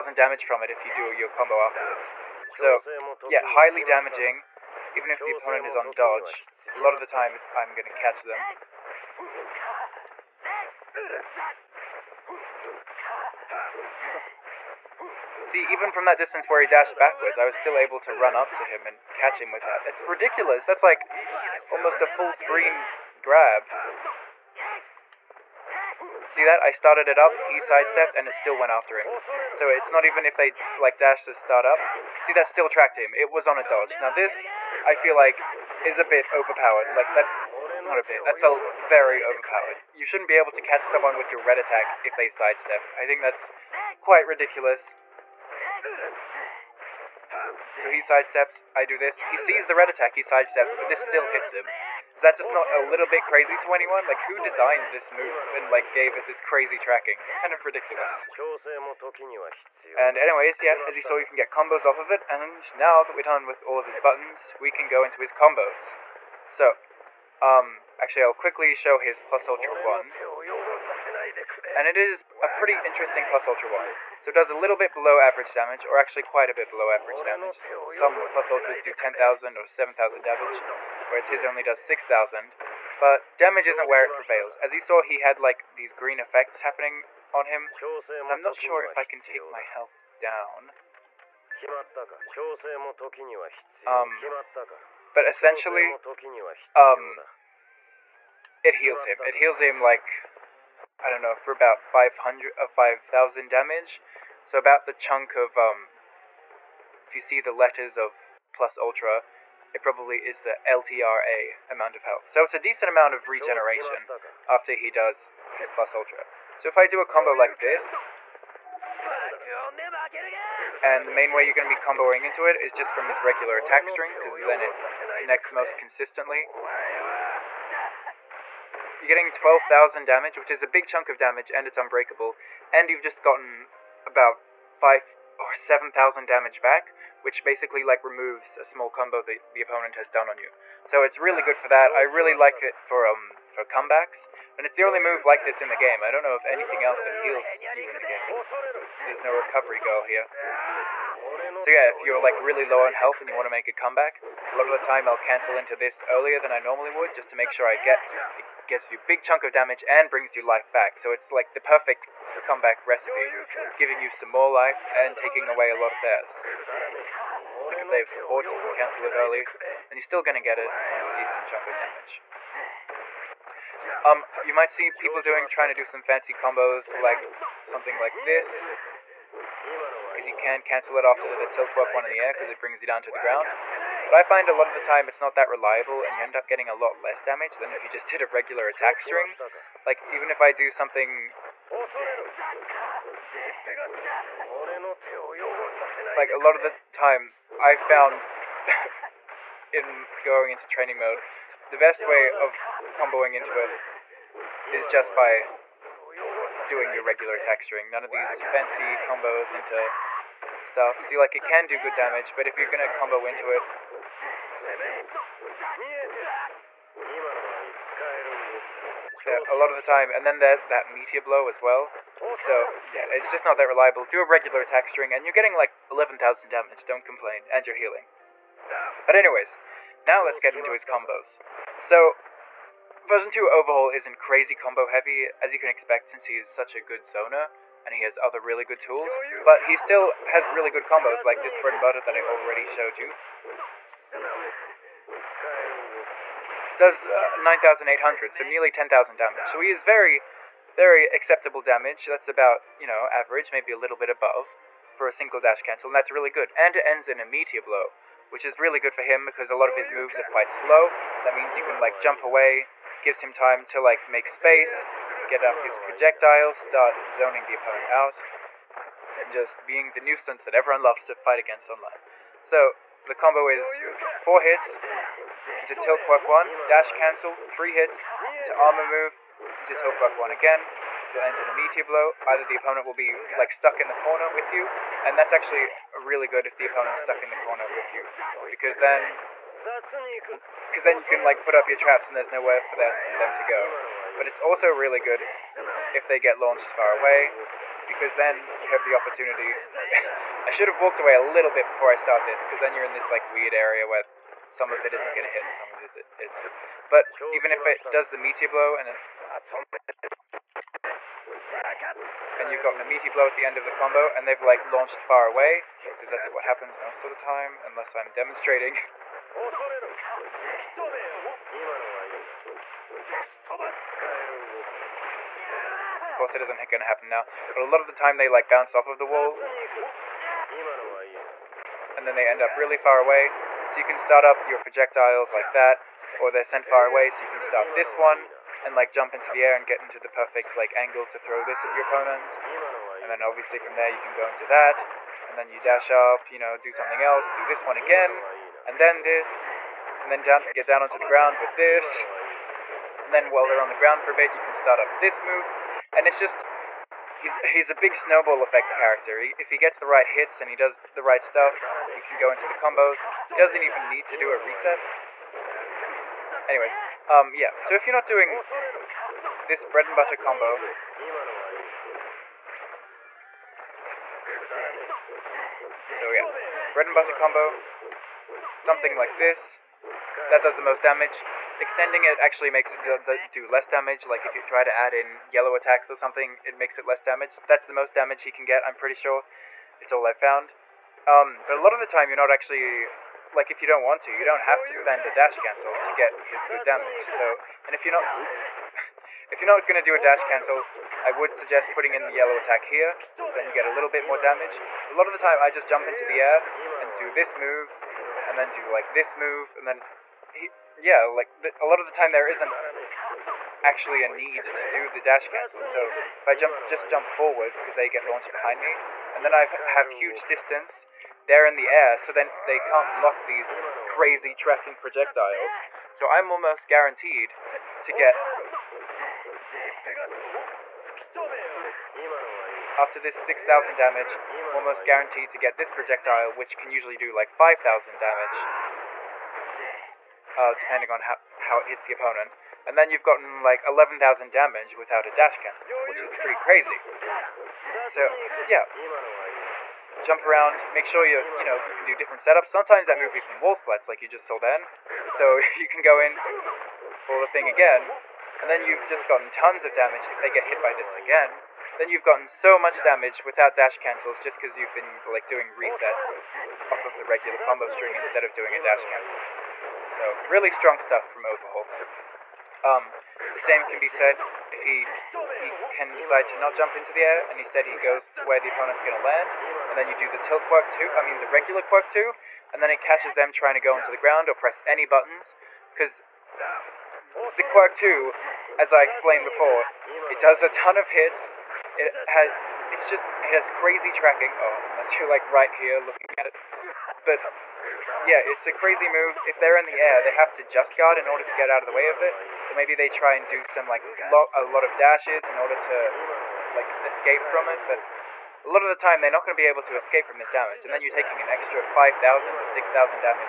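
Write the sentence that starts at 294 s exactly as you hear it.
But it's also really good if they get launched far away, because then you have the opportunity.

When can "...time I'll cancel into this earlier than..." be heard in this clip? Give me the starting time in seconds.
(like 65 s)
154 s.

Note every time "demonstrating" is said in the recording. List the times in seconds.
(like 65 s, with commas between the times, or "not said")
318 s.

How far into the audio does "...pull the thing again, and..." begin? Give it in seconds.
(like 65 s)
457 s.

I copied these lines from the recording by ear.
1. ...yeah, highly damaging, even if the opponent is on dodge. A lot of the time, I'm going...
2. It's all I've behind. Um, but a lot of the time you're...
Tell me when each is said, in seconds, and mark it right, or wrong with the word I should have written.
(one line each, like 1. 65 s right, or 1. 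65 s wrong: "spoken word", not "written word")
1. 3 s right
2. 389 s wrong: "found", not "behind".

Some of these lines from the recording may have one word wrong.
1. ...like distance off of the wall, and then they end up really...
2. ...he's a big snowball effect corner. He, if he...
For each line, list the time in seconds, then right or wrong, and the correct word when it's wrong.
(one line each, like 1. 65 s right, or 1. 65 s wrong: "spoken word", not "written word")
1. 328 s wrong: "bounce", not "distance"
2. 357 s wrong: "character", not "corner".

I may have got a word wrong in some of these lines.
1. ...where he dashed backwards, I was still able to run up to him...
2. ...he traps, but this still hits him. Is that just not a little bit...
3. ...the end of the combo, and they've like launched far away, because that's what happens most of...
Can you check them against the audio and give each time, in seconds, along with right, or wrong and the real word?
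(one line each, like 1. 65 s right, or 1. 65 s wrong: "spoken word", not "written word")
1. 16 s right
2. 50 s wrong: "sidesteps", not "traps"
3. 313 s right.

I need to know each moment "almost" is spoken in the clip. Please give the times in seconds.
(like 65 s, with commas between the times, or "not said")
21 s, 426 s, 434 s.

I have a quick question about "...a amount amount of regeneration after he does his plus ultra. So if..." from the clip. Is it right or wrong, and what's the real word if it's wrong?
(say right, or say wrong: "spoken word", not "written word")
wrong: "decent", not "amount".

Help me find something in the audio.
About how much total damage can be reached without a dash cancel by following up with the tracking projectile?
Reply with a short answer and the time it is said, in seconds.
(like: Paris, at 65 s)
11,000, at 443 s.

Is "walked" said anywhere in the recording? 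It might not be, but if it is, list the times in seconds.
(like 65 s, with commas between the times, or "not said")
300 s.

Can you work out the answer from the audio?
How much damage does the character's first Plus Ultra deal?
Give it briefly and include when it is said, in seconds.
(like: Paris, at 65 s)
6,000, at 81 s.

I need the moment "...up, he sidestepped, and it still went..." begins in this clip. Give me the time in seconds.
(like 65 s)
27 s.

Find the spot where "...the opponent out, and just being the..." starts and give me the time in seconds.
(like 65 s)
267 s.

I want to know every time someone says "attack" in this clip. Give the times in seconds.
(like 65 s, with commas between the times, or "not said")
41 s, 49 s, 123 s, 188 s, 207 s, 224 s, 385 s, 402 s.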